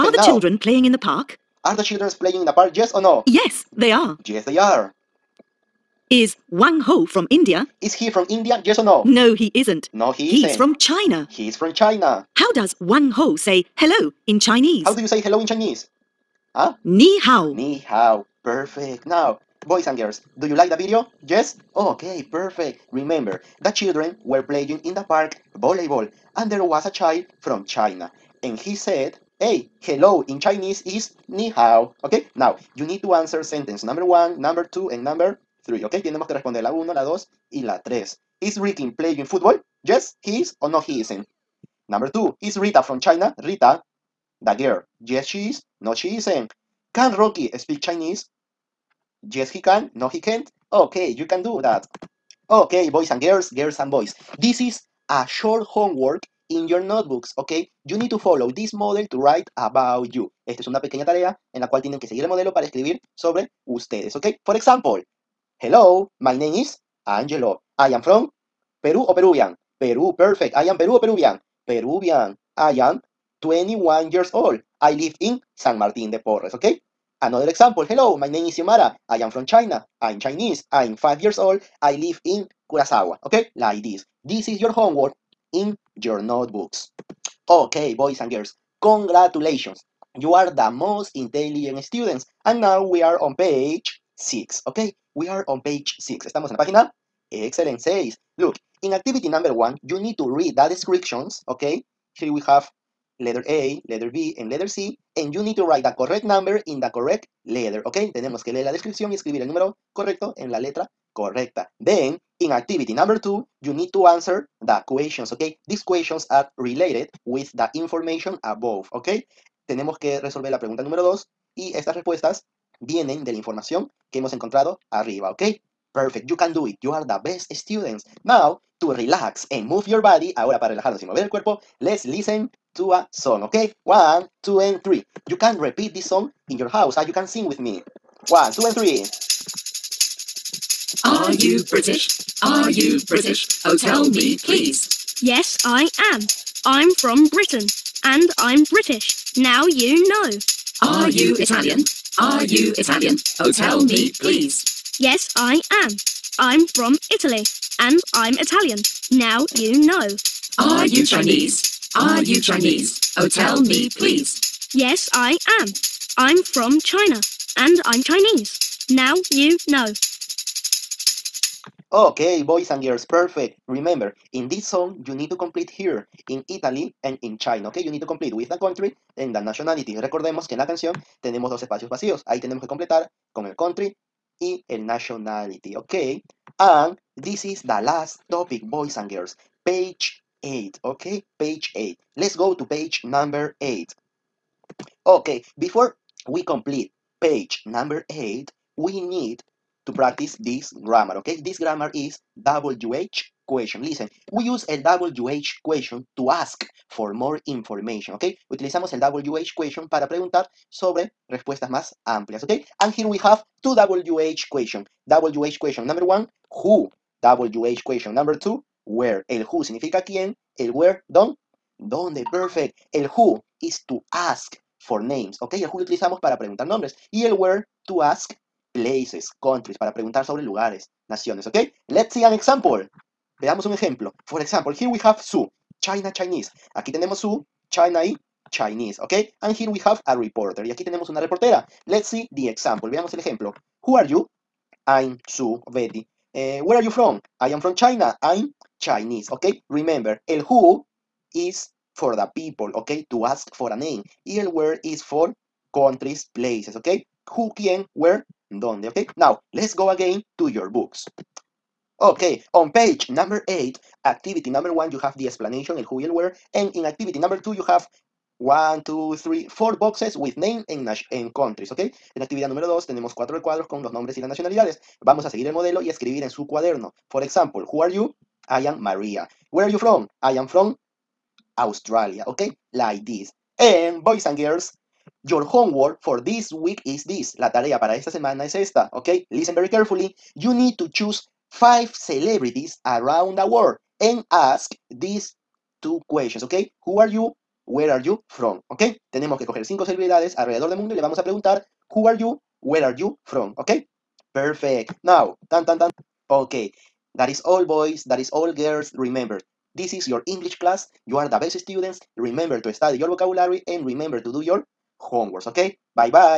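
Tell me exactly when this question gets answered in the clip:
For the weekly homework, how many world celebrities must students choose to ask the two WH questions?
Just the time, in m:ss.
4:51.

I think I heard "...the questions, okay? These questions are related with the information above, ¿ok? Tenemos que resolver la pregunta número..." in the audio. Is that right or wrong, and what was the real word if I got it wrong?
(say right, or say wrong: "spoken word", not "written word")
right.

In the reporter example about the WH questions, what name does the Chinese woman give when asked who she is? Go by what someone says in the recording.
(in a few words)
Su Betty.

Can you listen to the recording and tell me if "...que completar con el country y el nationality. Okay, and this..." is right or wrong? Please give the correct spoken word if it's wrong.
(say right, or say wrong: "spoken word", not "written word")
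right.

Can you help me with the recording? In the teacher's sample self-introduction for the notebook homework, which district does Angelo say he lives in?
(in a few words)
San Martín de Porres.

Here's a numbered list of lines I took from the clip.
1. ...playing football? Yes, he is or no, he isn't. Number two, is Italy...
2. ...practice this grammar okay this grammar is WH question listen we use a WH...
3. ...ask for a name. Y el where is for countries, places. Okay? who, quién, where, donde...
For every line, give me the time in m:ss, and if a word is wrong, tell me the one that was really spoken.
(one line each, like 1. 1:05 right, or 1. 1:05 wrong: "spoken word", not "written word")
1. 0:38 wrong: "Rita", not "Italy"
2. 3:19 right
3. 4:13 right.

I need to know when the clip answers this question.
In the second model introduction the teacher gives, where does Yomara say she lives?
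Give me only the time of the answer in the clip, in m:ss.
1:22.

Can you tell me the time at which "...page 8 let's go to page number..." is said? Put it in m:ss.
3:11.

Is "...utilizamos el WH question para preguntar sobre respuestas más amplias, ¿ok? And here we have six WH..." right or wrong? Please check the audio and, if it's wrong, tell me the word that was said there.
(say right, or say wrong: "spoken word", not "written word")
wrong: "two", not "six".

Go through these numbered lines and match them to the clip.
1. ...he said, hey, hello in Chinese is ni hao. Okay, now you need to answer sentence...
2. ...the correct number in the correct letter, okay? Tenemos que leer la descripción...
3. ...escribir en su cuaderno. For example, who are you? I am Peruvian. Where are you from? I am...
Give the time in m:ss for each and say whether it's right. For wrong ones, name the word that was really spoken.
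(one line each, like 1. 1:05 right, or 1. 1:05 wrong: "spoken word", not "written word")
1. 0:28 right
2. 1:45 right
3. 4:35 wrong: "Maria", not "Peruvian".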